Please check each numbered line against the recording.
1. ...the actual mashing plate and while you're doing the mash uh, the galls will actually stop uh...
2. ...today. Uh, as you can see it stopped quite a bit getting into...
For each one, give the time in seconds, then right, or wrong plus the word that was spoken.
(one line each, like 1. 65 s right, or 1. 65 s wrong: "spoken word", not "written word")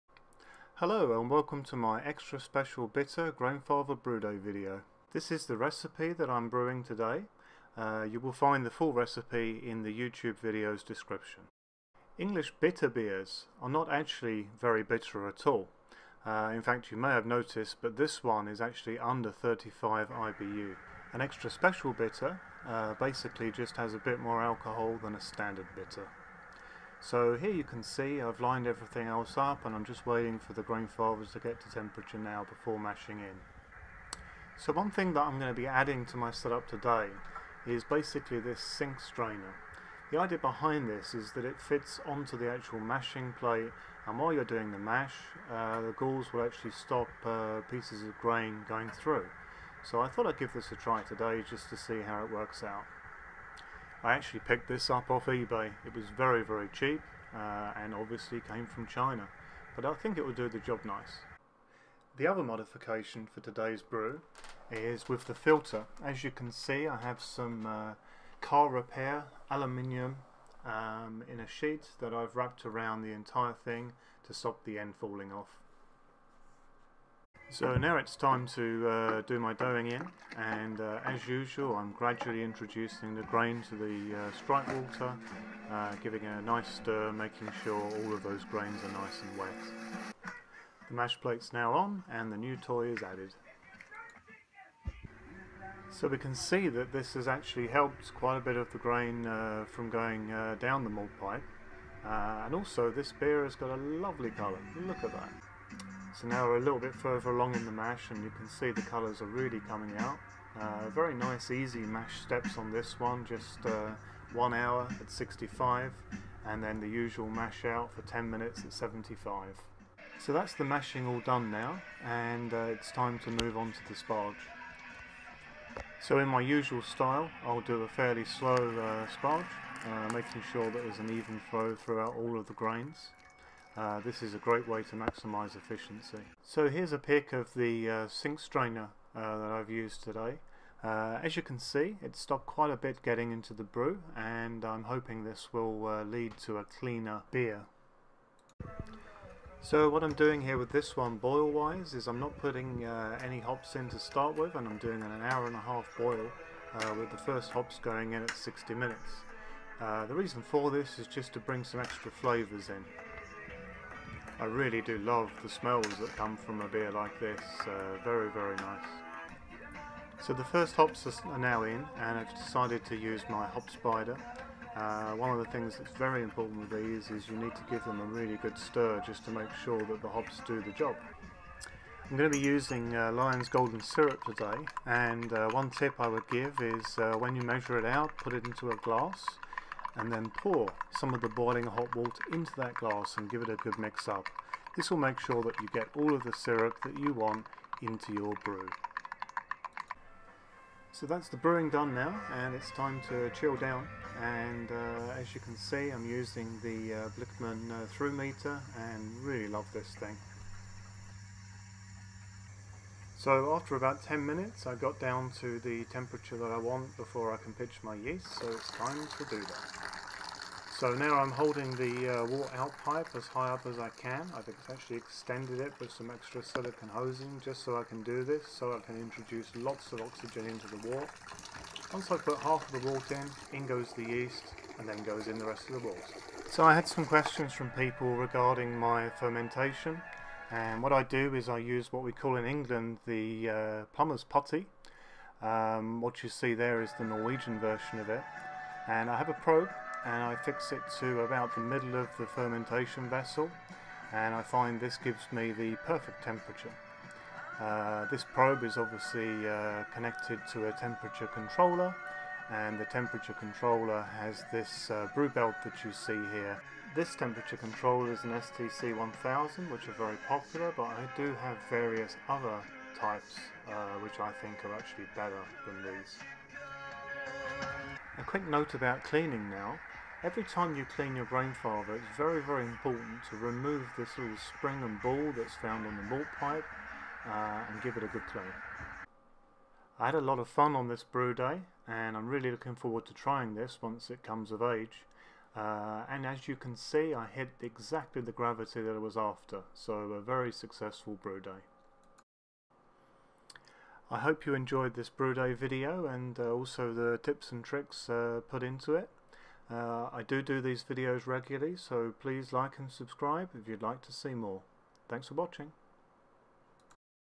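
1. 42 s right
2. 140 s right.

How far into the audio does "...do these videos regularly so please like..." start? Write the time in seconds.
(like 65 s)
310 s.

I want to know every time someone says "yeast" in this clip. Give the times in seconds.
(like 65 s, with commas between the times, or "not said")
217 s, 234 s.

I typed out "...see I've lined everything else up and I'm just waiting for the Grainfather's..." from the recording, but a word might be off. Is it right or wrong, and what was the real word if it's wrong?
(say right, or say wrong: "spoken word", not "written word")
right.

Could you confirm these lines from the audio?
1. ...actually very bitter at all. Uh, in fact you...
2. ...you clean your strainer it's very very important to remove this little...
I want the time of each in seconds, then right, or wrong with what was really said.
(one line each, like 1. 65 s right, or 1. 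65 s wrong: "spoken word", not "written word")
1. 13 s right
2. 280 s wrong: "grainfather", not "strainer".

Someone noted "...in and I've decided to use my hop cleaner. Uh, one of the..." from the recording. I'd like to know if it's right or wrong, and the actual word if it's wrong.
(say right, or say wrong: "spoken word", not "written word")
wrong: "spider", not "cleaner".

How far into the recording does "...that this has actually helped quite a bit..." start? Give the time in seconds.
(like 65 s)
96 s.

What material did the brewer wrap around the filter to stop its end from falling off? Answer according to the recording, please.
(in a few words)
car repair aluminium.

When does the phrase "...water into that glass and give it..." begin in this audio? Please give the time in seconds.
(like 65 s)
191 s.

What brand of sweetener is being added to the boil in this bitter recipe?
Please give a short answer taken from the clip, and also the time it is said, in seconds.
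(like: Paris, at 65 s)
Lyons Golden Syrup, at 183 s.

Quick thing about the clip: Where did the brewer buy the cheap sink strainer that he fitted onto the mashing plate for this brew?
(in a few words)
eBay.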